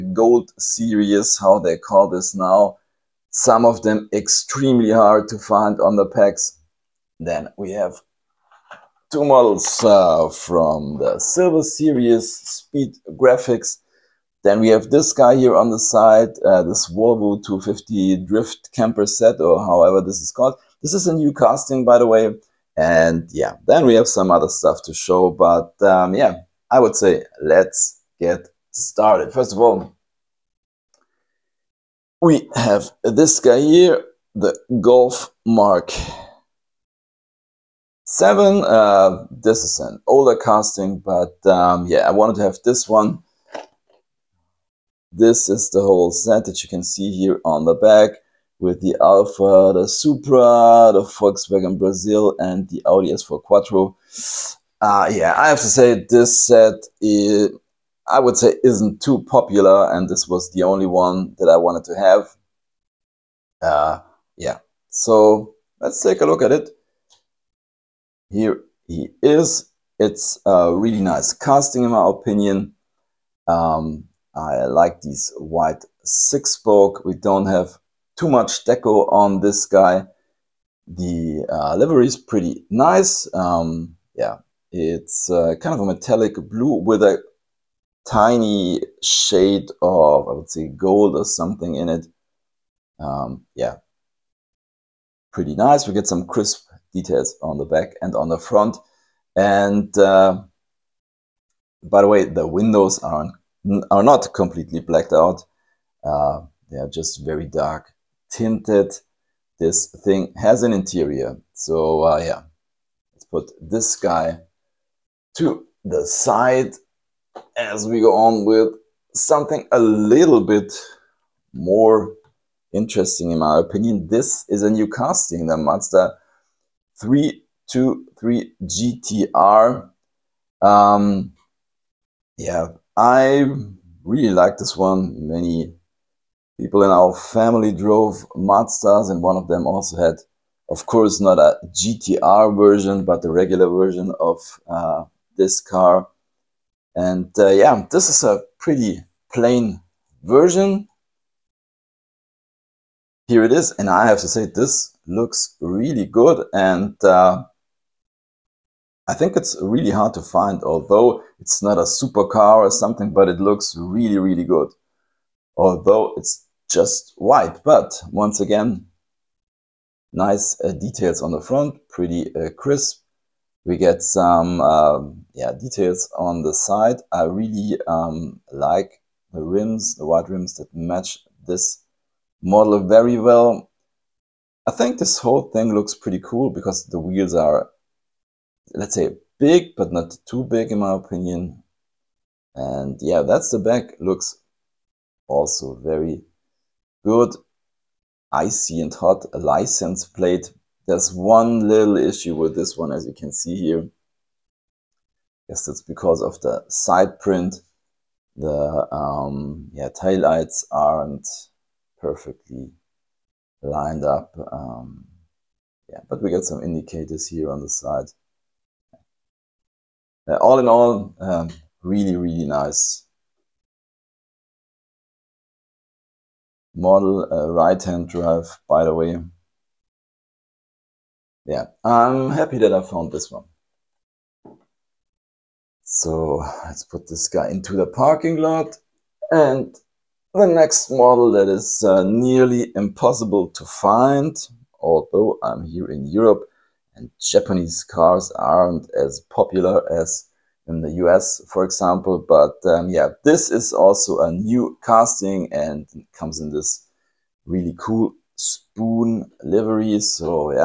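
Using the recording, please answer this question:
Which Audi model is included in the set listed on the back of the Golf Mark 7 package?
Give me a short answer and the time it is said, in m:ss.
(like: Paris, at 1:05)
S4 Quattro, at 0:52.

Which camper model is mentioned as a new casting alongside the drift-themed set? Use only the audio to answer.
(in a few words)
Volvo 250.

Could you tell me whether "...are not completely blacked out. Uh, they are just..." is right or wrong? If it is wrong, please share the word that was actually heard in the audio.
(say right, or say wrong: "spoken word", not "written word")
right.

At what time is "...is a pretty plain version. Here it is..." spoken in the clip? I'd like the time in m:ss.
2:28.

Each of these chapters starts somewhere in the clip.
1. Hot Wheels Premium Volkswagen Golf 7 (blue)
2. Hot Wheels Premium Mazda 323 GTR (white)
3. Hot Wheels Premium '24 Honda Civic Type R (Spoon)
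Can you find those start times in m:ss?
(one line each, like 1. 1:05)
1. 0:30
2. 1:59
3. 3:58.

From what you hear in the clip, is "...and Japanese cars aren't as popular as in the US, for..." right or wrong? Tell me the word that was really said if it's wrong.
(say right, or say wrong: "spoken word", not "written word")
right.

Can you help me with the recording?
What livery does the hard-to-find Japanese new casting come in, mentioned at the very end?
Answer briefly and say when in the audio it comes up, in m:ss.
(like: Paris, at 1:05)
Spoon, at 4:18.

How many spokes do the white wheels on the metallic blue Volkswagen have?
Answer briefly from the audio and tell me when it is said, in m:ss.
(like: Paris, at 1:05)
6, at 1:16.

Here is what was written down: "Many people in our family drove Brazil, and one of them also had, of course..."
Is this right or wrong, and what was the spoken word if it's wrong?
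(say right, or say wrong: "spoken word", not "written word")
wrong: "Mazdas", not "Brazil".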